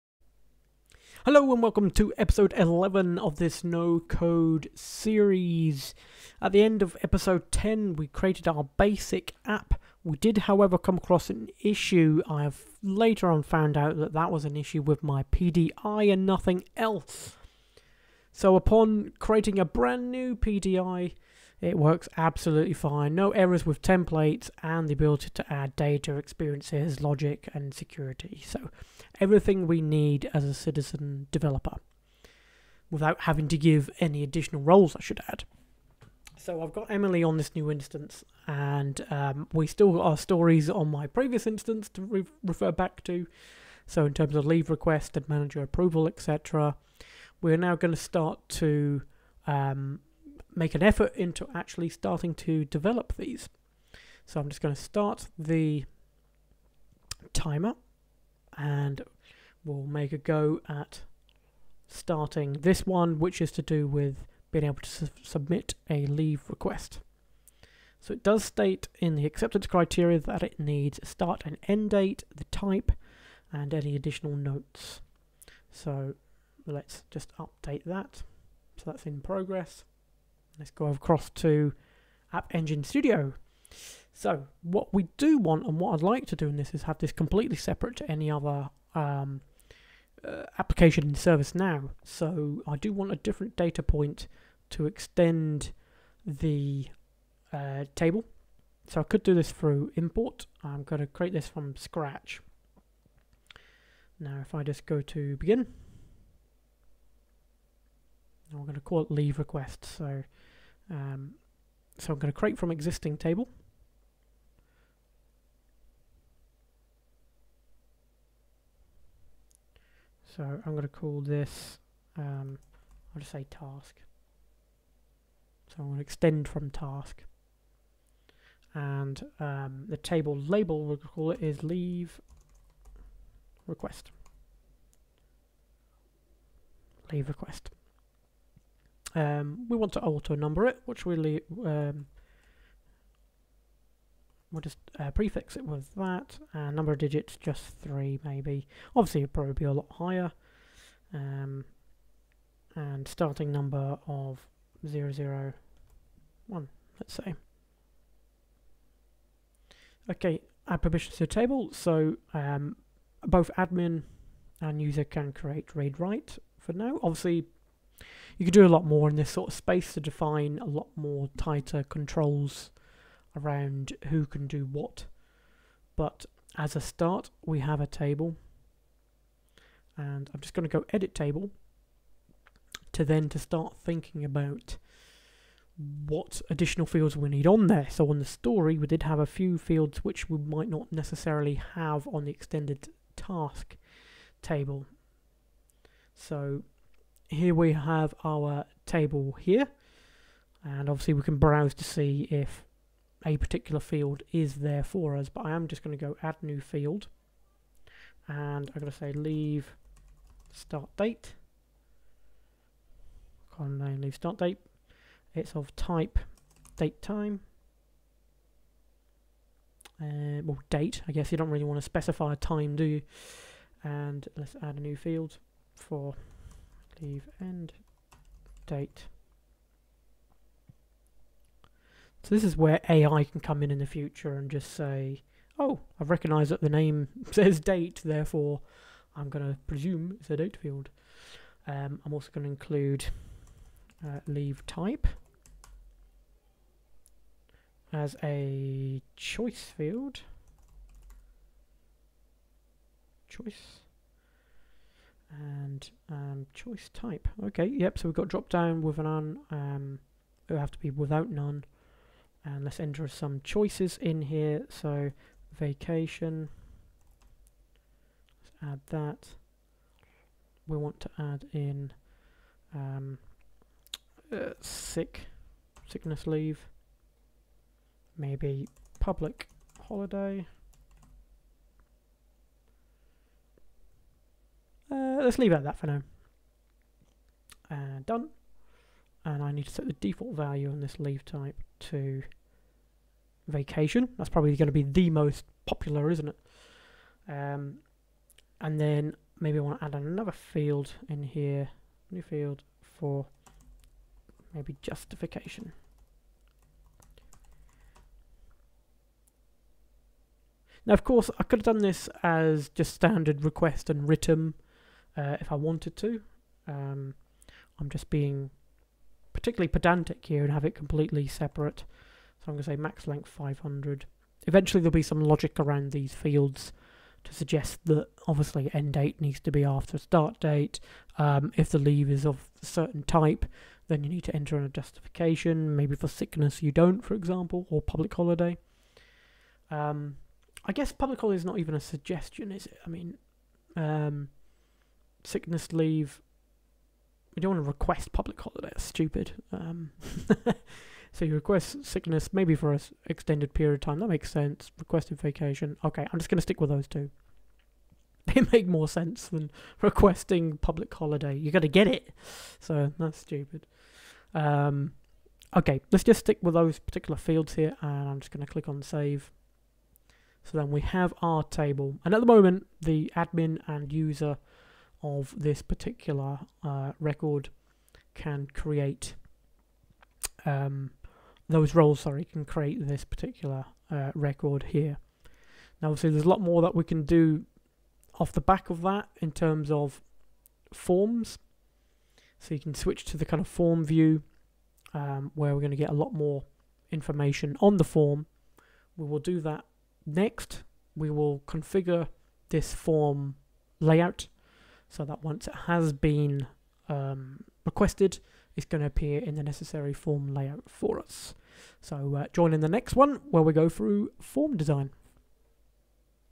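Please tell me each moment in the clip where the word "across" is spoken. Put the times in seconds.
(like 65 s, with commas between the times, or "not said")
10 s, 80 s.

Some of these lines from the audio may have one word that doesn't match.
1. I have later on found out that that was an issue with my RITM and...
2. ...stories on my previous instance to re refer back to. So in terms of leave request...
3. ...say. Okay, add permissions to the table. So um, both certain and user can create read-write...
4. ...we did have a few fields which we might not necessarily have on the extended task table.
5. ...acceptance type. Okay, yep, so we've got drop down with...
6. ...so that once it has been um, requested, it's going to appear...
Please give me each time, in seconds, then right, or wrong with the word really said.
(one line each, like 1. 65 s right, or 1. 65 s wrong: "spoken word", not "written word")
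1. 12 s wrong: "PDI", not "RITM"
2. 40 s right
3. 157 s wrong: "admin", not "certain"
4. 188 s right
5. 256 s wrong: "choice", not "acceptance"
6. 404 s right.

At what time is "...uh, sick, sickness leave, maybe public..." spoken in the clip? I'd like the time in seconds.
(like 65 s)
274 s.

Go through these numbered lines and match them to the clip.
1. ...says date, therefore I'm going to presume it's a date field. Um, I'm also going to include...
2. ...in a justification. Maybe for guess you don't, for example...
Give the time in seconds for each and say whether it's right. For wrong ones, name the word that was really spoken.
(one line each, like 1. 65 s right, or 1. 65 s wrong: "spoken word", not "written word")
1. 237 s right
2. 334 s wrong: "sickness", not "guess".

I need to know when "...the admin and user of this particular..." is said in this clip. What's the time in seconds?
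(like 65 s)
372 s.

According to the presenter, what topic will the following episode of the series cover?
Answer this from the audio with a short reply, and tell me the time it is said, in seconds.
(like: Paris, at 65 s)
Form design, at 414 s.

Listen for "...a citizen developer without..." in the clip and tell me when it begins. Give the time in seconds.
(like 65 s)
30 s.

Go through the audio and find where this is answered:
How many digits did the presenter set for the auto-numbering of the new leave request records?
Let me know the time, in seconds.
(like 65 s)
147 s.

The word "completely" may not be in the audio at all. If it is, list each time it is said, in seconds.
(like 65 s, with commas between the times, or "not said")
87 s, 320 s.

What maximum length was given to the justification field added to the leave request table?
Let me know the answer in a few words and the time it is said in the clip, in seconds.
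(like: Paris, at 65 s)
500, at 323 s.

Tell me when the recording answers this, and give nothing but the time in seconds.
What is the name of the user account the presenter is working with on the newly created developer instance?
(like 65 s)
36 s.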